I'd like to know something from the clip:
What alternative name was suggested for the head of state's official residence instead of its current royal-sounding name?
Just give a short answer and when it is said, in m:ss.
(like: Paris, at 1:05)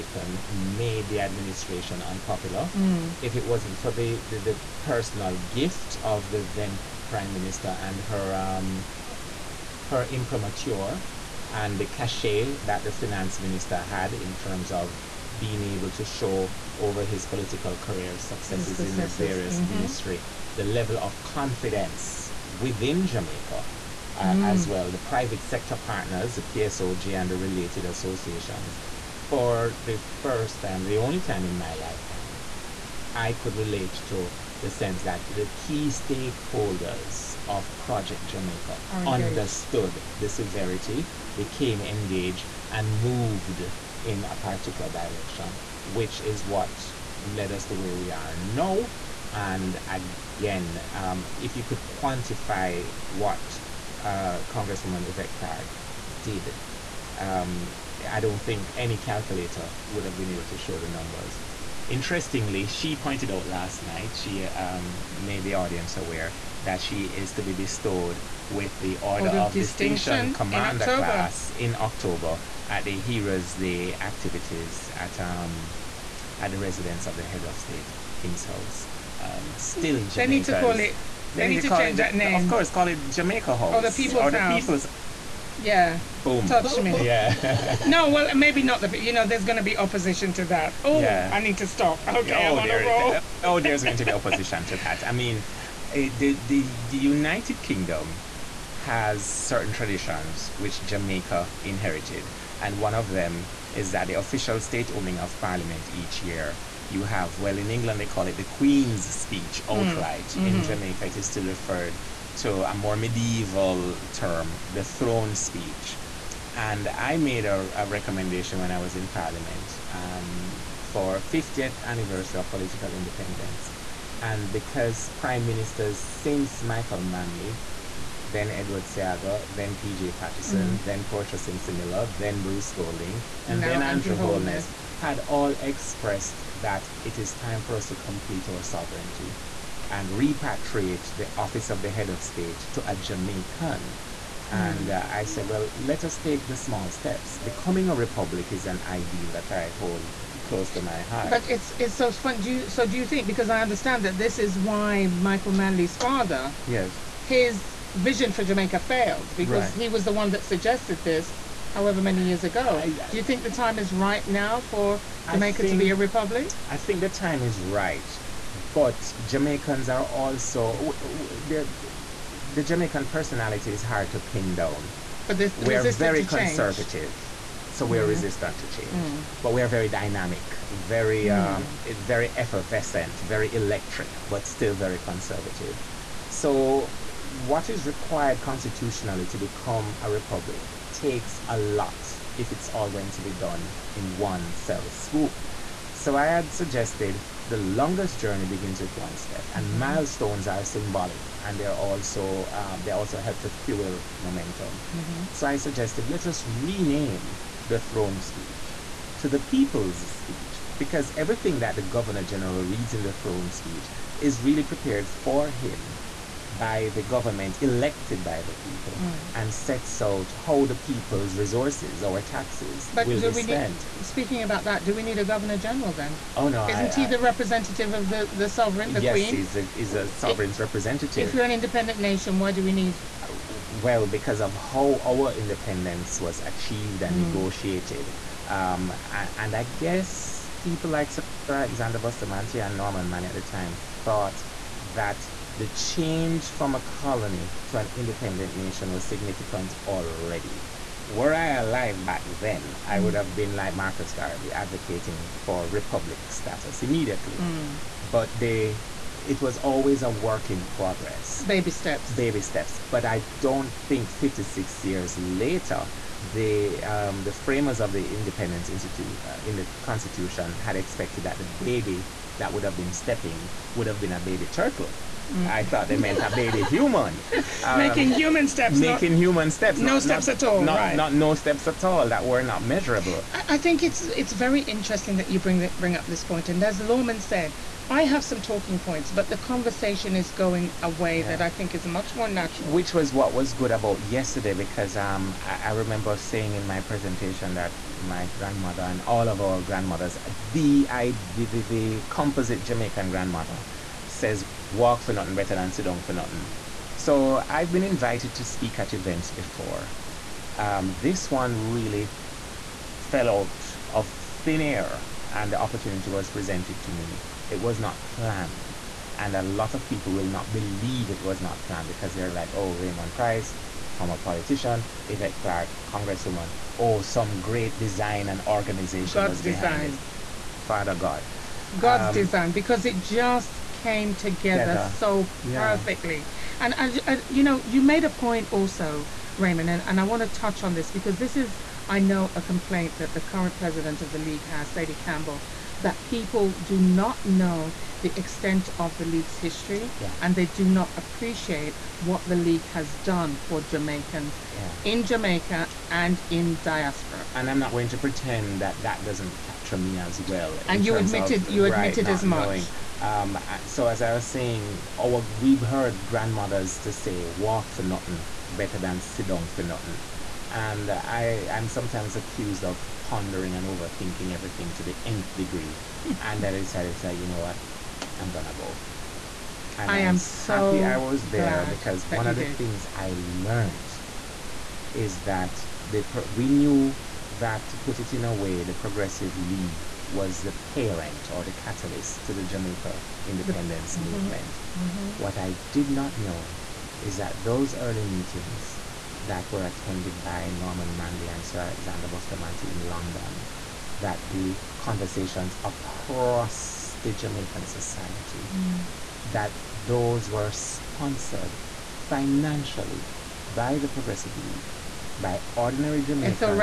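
Jamaica House, at 1:23.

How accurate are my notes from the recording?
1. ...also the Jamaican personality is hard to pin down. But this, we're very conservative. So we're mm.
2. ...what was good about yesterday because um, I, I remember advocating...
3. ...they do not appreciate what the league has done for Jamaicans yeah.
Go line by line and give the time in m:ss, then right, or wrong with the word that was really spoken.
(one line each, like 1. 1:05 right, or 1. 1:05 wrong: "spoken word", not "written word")
1. 2:50 right
2. 4:53 wrong: "saying", not "advocating"
3. 5:50 right.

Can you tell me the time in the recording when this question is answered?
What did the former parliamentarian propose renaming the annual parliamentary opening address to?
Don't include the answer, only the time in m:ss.
3:29.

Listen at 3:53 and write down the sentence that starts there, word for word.
Uh, well, because of how our independence was achieved and mm.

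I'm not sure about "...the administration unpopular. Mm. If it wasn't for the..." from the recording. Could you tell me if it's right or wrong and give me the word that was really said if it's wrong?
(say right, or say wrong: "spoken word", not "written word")
right.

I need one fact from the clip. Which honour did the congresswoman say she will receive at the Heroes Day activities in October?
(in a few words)
Order of Distinction.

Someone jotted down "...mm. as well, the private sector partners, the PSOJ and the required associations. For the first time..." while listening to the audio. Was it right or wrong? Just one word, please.
wrong.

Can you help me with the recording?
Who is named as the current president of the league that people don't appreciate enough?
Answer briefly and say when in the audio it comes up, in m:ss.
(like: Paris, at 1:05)
Sadie Campbell, at 5:44.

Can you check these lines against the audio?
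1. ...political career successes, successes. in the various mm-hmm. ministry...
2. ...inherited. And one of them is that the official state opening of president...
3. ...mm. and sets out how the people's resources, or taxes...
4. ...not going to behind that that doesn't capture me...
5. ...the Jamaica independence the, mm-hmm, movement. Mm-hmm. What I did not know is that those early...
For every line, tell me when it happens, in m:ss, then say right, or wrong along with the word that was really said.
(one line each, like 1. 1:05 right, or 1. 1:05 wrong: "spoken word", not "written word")
1. 0:17 right
2. 1:41 wrong: "parliament", not "president"
3. 3:38 right
4. 5:57 wrong: "pretend", not "behind"
5. 6:32 right.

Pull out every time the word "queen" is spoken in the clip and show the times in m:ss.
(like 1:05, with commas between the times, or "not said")
1:48, 3:49.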